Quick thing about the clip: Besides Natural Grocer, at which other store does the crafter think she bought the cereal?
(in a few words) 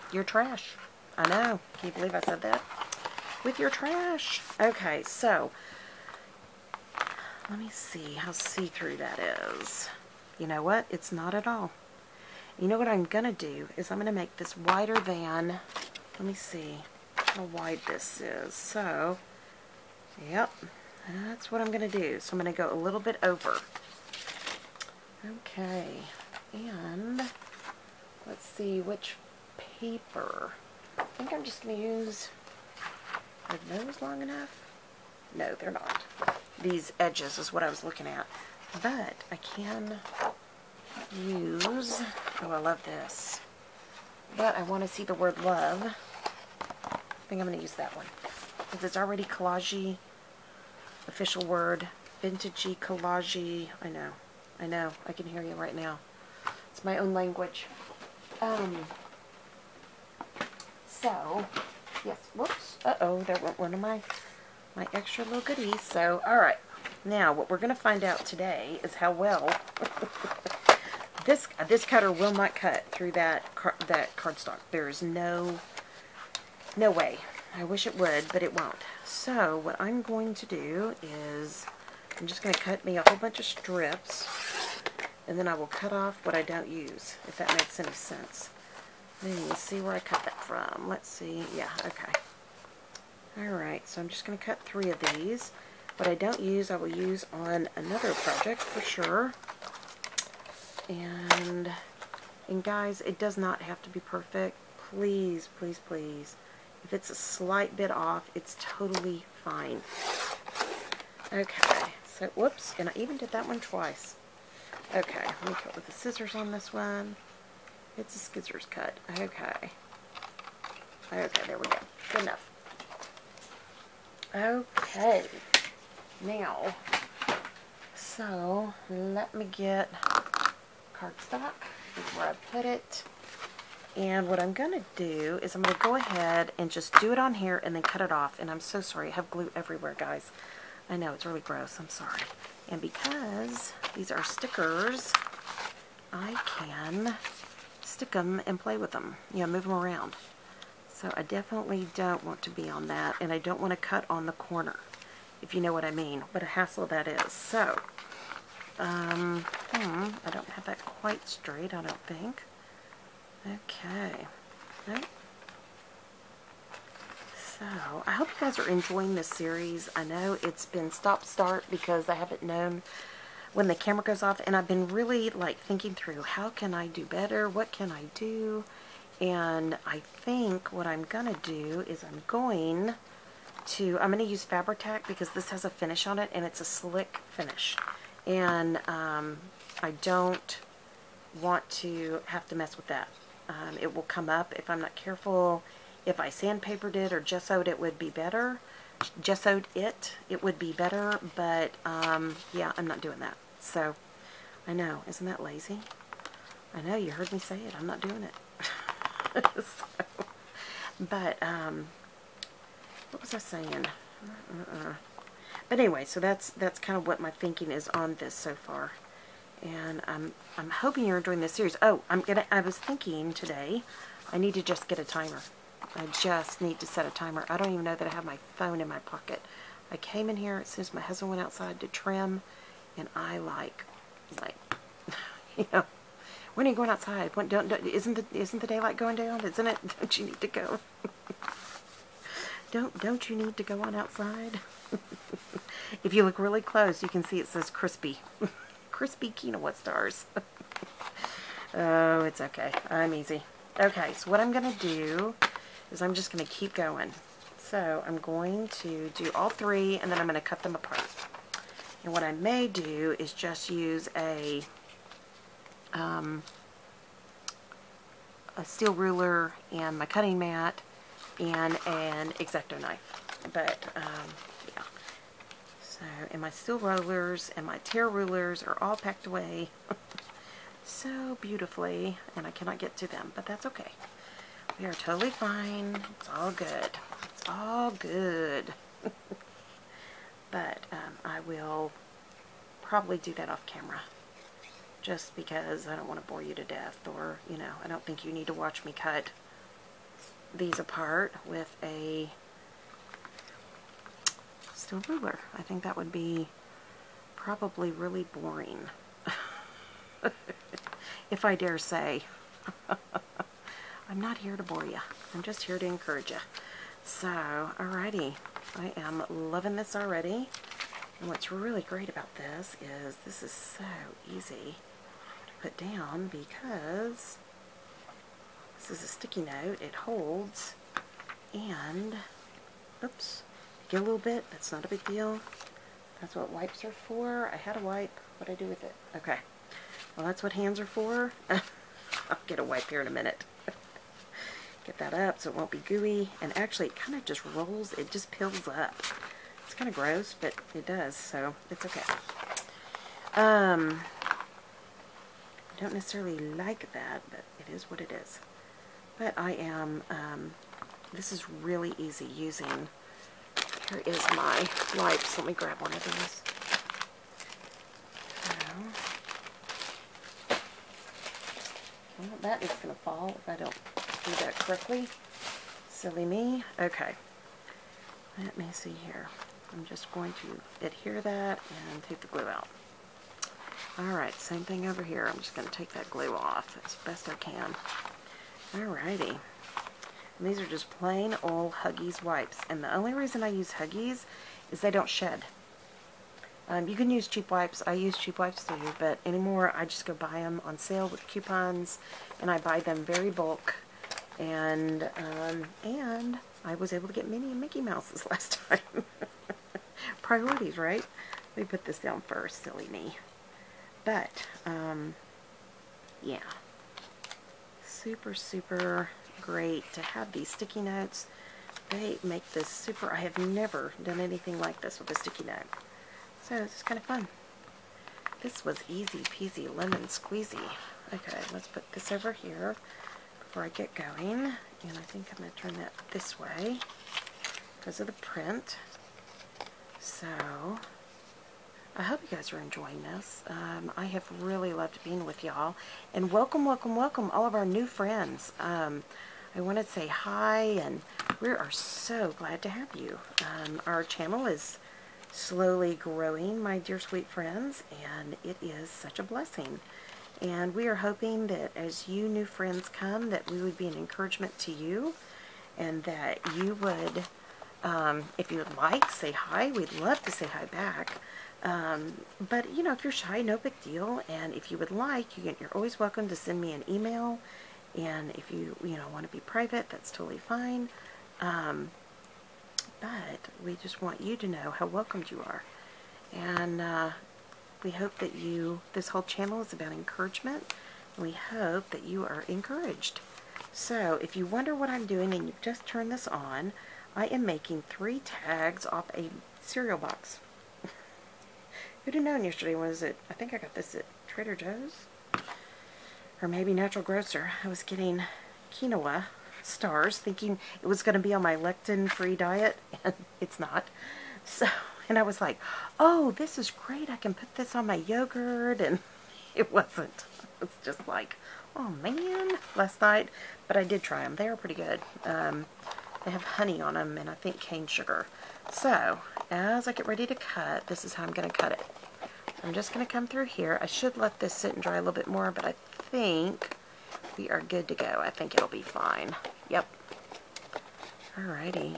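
Trader Joe's.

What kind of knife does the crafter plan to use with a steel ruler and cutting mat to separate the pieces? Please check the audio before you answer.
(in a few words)
X-Acto knife.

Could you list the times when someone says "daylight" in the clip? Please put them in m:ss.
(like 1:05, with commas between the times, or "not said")
3:58.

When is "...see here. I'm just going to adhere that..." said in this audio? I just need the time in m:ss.
6:18.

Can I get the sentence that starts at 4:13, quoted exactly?
Okay, so what I'm gonna do is I'm just going to keep going.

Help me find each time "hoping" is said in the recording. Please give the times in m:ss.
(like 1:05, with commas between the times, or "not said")
3:40, 7:40.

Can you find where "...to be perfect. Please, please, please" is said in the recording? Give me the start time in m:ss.
1:43.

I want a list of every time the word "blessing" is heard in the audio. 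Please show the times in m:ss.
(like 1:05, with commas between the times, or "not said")
7:39.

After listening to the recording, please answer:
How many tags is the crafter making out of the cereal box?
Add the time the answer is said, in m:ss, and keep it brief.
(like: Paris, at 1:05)
3, at 8:17.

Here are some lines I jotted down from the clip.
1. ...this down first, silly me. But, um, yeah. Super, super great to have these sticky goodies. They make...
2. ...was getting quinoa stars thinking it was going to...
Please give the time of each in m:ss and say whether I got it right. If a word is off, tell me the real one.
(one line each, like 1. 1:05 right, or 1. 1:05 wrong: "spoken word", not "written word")
1. 6:51 wrong: "notes", not "goodies"
2. 8:27 right.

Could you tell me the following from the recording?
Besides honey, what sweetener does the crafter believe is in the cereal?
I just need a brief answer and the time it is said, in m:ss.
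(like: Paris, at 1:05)
cane sugar, at 8:47.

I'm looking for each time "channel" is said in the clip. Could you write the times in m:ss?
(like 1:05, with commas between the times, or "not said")
7:34, 8:09.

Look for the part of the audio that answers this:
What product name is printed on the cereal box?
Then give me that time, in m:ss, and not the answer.
4:08.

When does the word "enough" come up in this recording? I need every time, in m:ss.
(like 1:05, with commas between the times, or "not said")
0:34, 2:02.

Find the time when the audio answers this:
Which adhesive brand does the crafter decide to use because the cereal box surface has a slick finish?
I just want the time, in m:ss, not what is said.
3:04.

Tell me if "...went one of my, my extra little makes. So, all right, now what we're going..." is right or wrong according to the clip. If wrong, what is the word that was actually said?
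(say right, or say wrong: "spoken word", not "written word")
wrong: "goodies", not "makes".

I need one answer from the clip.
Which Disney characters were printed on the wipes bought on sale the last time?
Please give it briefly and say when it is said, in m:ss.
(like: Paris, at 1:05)
Minnie and Mickey Mouse, at 6:47.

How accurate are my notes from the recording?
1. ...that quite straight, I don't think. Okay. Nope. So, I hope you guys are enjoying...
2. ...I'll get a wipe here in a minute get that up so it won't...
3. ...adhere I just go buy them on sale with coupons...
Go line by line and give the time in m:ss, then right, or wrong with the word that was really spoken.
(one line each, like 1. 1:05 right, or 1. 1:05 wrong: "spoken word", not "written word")
1. 2:40 right
2. 5:41 right
3. 6:39 wrong: "anymore", not "adhere".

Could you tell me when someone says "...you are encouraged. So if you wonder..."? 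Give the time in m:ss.
8:12.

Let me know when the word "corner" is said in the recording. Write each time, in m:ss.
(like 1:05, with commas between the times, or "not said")
2:34.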